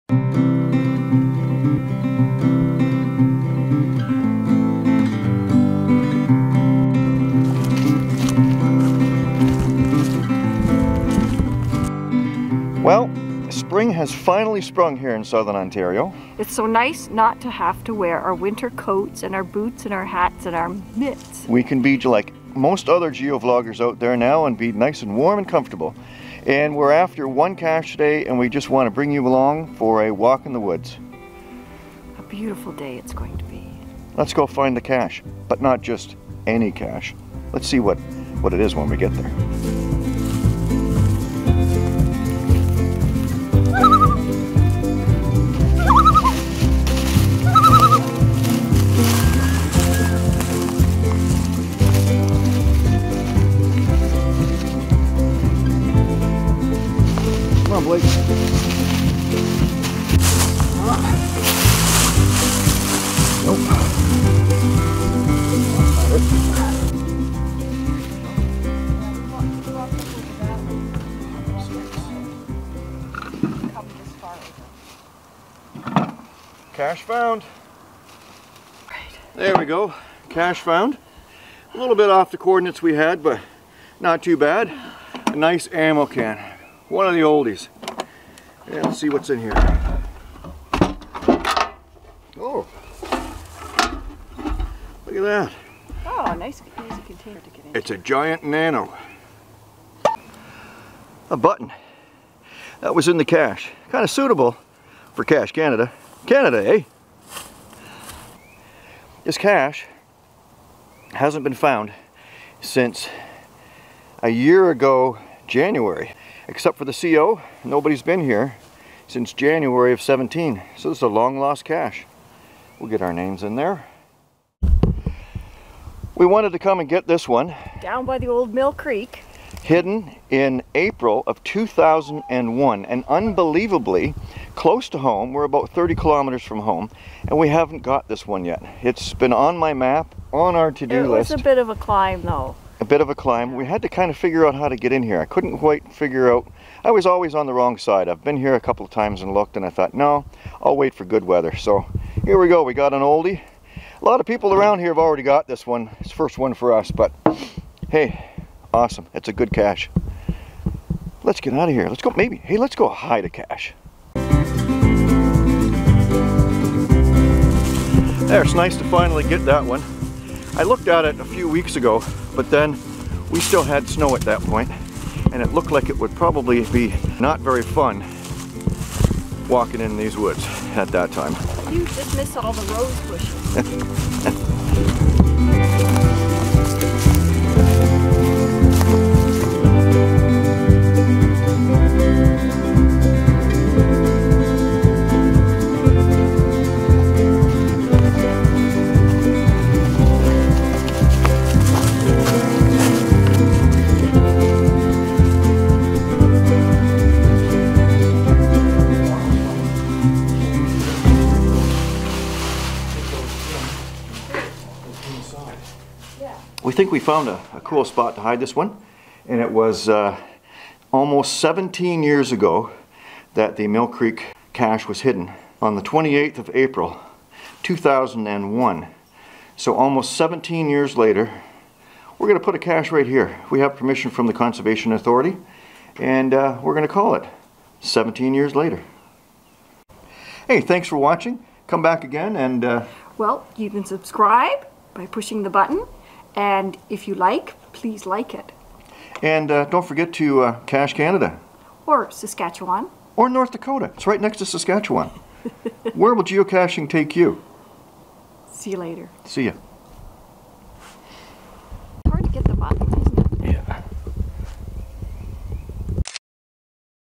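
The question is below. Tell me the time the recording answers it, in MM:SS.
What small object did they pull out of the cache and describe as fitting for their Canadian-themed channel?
01:41.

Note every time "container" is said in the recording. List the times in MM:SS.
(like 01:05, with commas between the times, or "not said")
01:37.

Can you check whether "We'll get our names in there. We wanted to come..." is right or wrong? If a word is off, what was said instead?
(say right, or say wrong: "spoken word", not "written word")
right.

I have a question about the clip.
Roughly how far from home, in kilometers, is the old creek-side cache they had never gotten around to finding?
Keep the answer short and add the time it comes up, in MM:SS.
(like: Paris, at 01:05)
30, at 02:15.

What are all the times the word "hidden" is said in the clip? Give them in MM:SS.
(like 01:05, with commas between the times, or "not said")
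02:09, 03:45.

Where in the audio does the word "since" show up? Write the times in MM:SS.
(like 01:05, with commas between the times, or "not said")
01:52, 01:59.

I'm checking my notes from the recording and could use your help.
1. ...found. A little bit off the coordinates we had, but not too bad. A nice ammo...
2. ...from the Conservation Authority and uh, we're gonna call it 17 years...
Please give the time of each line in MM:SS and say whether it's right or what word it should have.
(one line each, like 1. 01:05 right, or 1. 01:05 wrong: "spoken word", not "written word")
1. 01:20 right
2. 03:54 right.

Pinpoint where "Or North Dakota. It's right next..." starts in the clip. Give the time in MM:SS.
04:13.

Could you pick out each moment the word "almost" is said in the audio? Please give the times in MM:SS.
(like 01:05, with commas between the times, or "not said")
03:40, 03:49.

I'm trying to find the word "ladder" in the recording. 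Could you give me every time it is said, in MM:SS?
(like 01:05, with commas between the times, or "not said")
not said.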